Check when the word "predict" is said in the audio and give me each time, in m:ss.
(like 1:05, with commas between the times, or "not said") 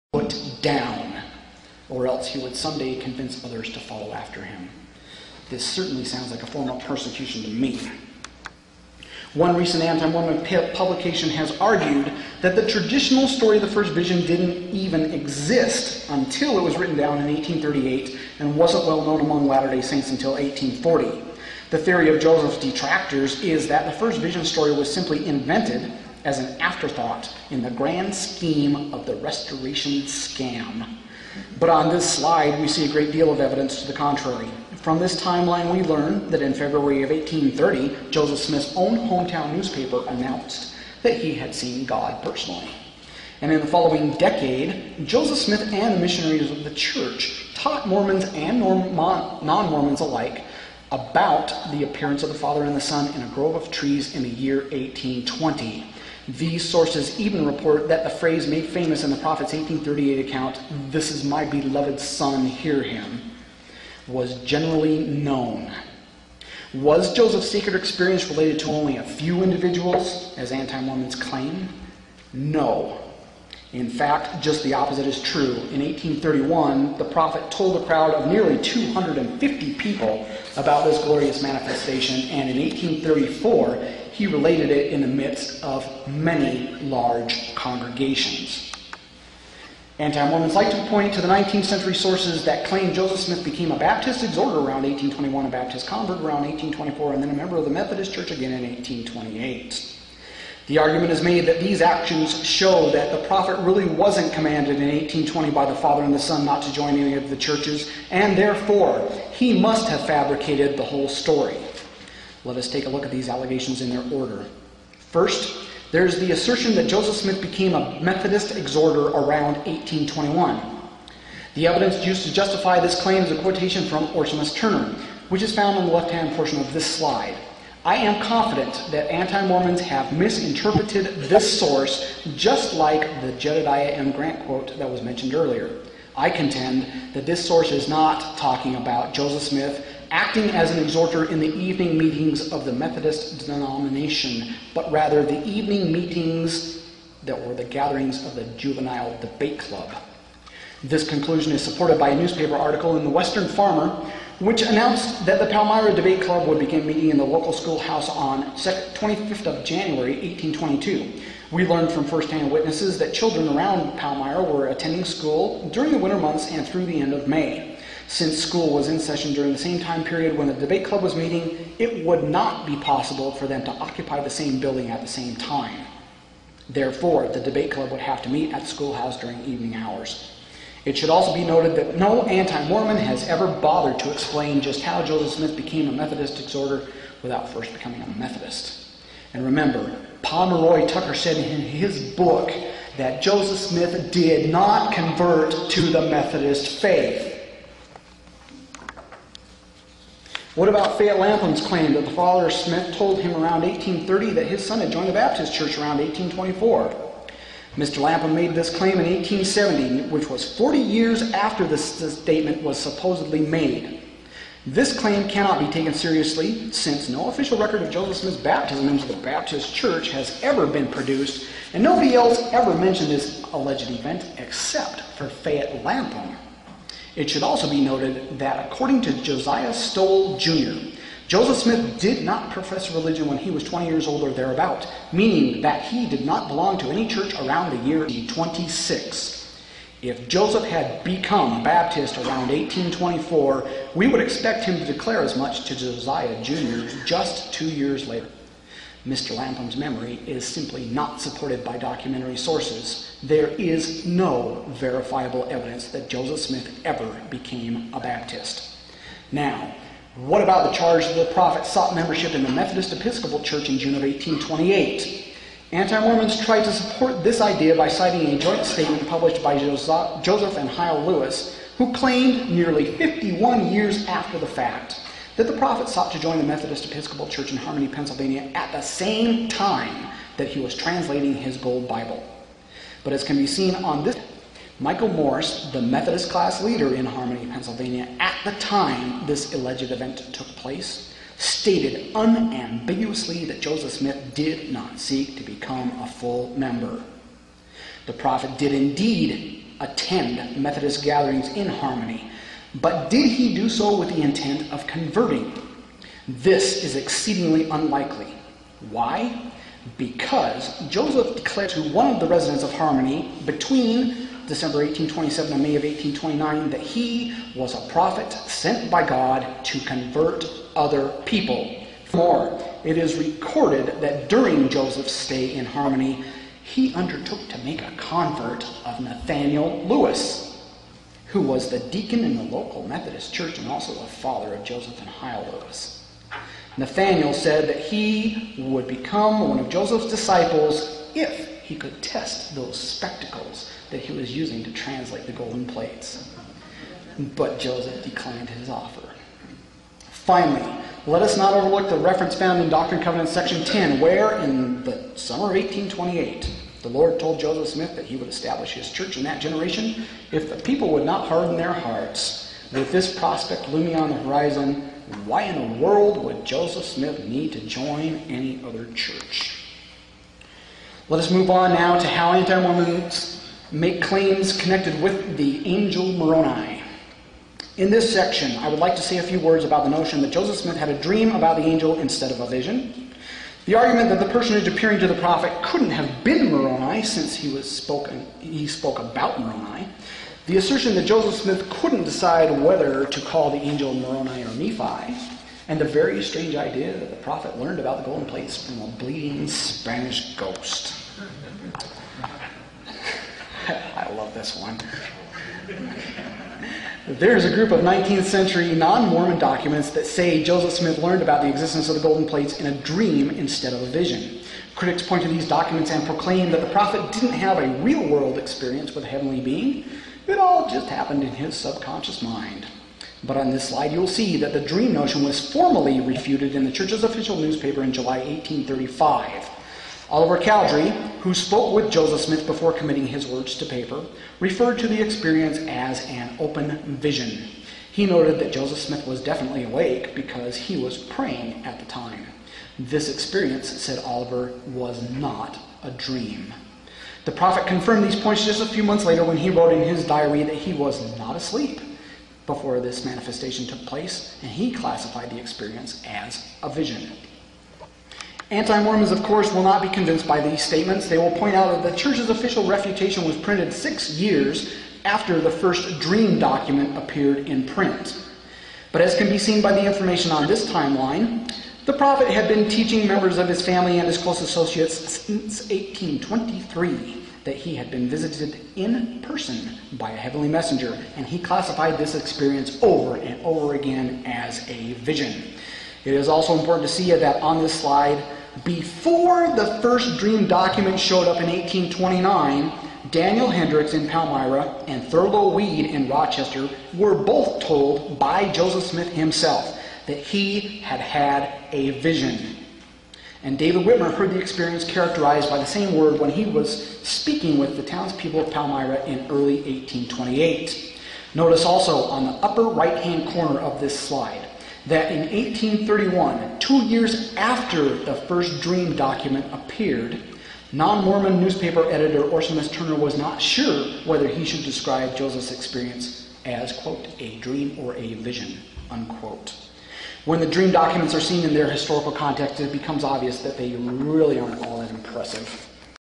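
not said.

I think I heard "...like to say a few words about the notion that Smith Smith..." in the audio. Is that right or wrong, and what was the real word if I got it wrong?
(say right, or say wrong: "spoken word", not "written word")
wrong: "Joseph", not "Smith".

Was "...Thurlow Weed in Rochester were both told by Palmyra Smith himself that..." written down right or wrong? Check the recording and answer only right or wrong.
wrong.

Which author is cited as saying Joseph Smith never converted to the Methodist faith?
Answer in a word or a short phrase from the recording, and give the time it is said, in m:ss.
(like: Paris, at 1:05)
Pomeroy Tucker, at 3:10.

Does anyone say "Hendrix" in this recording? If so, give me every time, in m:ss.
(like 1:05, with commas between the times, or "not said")
8:13.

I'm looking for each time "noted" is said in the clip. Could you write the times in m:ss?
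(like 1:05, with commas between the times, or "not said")
3:01, 3:47, 7:18.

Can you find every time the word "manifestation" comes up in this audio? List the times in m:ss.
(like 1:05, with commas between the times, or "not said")
1:21, 7:33.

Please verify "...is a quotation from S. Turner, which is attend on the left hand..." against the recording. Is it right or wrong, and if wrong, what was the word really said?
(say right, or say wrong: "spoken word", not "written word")
wrong: "found", not "attend".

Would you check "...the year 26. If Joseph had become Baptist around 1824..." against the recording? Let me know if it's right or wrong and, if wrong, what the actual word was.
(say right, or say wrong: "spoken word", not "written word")
right.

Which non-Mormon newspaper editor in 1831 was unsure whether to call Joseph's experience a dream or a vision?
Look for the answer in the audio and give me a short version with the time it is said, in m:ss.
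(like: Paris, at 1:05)
Orson Turner, at 8:42.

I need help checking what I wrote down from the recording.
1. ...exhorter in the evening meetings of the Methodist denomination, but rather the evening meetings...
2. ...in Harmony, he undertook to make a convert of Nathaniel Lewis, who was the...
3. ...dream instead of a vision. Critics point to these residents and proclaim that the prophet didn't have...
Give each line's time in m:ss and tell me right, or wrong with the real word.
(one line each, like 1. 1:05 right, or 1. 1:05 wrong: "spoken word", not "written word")
1. 2:20 right
2. 5:25 right
3. 6:52 wrong: "documents", not "residents".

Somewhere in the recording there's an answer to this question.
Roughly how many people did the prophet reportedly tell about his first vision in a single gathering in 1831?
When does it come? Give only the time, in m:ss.
1:18.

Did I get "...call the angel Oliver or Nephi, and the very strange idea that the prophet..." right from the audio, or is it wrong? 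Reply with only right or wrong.
wrong.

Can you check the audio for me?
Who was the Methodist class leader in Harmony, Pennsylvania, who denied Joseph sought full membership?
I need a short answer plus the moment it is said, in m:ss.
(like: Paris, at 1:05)
Michael Morse, at 4:44.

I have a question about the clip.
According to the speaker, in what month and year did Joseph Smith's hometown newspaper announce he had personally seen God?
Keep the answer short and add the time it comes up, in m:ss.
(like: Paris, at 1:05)
February 1830, at 0:36.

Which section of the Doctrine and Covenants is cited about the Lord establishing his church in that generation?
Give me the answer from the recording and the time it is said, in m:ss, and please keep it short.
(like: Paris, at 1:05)
Section 10, at 5:53.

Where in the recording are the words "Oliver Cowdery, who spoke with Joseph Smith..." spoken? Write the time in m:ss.
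7:10.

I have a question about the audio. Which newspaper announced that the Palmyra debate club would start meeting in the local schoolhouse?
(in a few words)
Western Farmer.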